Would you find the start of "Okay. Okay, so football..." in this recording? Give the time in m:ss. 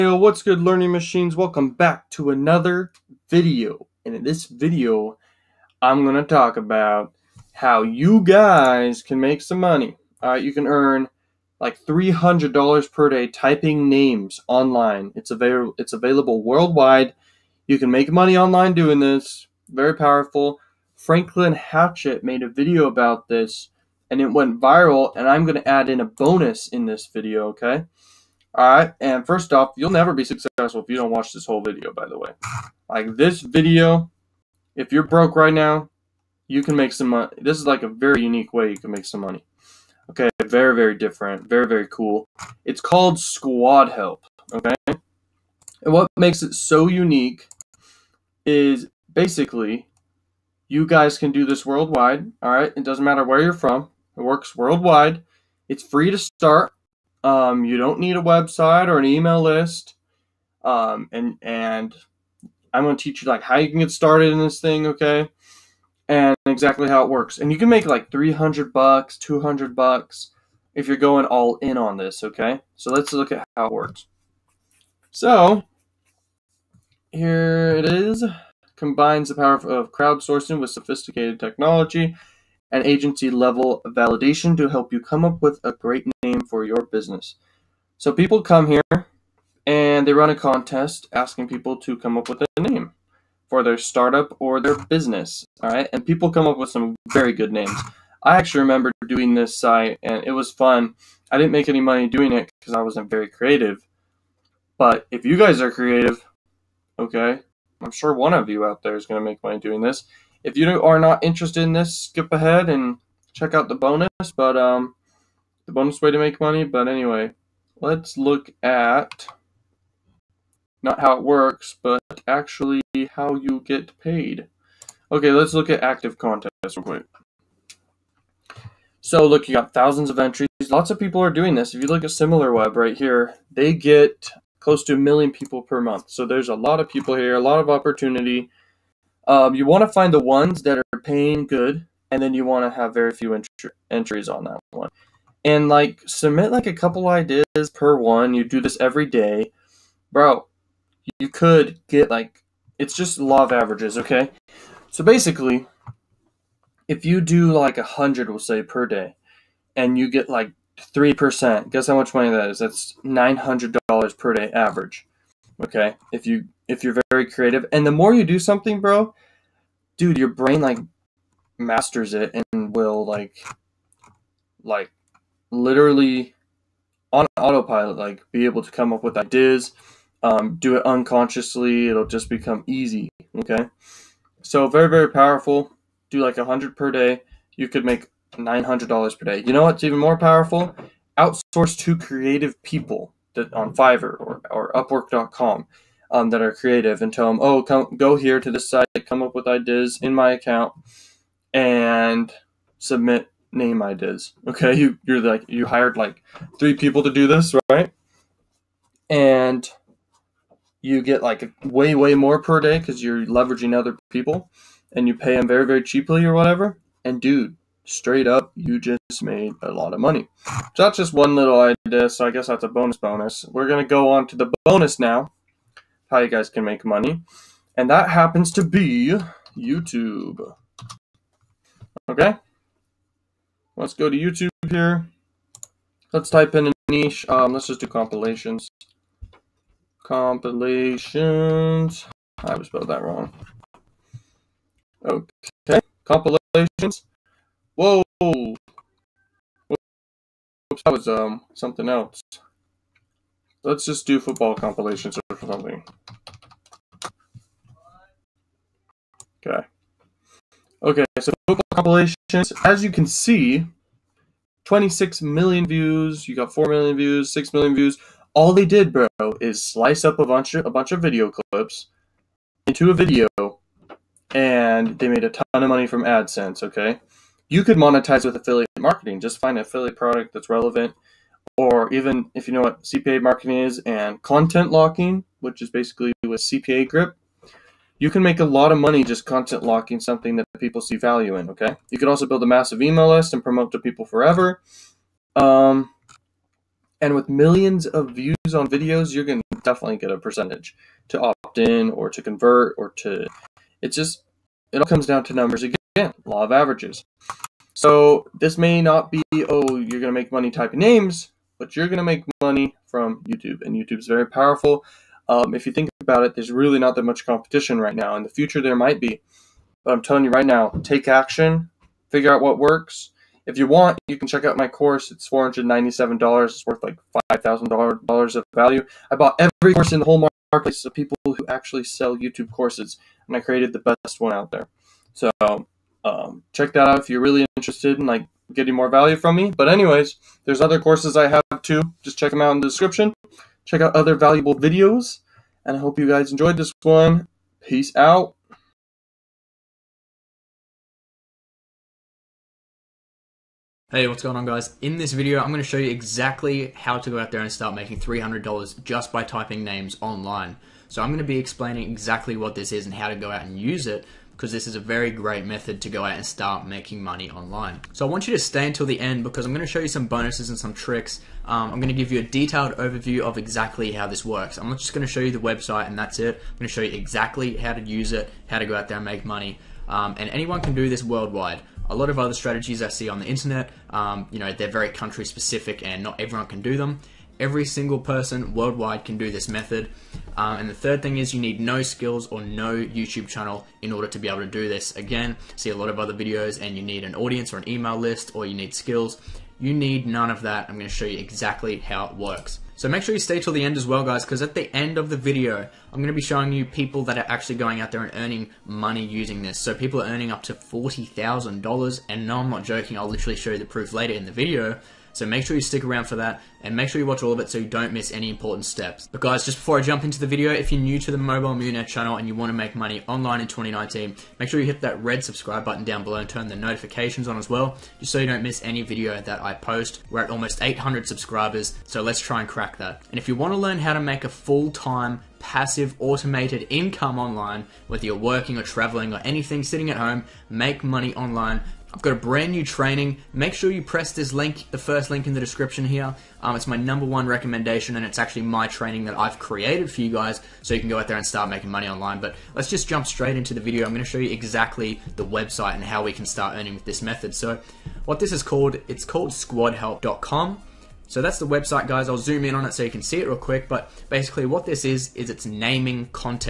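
4:19.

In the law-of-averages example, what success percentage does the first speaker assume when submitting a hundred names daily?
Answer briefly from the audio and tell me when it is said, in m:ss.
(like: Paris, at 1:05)
3%, at 2:40.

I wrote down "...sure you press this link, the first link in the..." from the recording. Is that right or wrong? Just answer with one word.
right.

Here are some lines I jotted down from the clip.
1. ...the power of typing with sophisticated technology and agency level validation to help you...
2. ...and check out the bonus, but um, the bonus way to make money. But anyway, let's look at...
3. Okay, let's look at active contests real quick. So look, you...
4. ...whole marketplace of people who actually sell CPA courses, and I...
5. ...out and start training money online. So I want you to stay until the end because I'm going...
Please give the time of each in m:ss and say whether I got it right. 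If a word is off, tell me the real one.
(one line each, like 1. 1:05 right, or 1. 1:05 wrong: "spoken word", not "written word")
1. 1:19 wrong: "crowdsourcing", not "typing"
2. 1:52 right
3. 2:05 right
4. 5:30 wrong: "YouTube", not "CPA"
5. 6:06 wrong: "making", not "training".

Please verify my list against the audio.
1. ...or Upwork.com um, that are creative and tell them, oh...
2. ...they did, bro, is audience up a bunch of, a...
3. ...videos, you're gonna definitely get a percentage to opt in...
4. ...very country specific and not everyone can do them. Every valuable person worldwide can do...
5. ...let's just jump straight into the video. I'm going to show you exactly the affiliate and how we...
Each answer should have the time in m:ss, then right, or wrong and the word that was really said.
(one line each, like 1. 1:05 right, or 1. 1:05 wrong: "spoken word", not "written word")
1. 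3:14 right
2. 4:28 wrong: "slice", not "audience"
3. 4:58 right
4. 6:24 wrong: "single", not "valuable"
5. 7:32 wrong: "website", not "affiliate".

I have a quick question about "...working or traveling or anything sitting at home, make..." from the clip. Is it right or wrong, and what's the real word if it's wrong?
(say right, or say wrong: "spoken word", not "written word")
right.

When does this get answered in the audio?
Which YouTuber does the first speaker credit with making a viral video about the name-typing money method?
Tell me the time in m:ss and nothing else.
0:20.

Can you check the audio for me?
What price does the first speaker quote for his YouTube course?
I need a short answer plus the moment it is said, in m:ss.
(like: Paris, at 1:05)
$497, at 5:25.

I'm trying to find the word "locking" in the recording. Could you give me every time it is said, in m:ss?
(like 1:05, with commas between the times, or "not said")
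4:44, 4:49.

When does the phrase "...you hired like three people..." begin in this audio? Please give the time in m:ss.
3:25.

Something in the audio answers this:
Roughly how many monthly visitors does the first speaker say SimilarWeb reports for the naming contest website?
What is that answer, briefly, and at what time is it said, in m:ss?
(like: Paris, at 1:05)
close to a million, at 2:14.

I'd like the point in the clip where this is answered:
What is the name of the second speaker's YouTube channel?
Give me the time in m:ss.
7:01.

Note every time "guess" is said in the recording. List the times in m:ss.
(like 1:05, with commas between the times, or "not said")
2:41, 3:42.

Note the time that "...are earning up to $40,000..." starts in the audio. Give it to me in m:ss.
6:50.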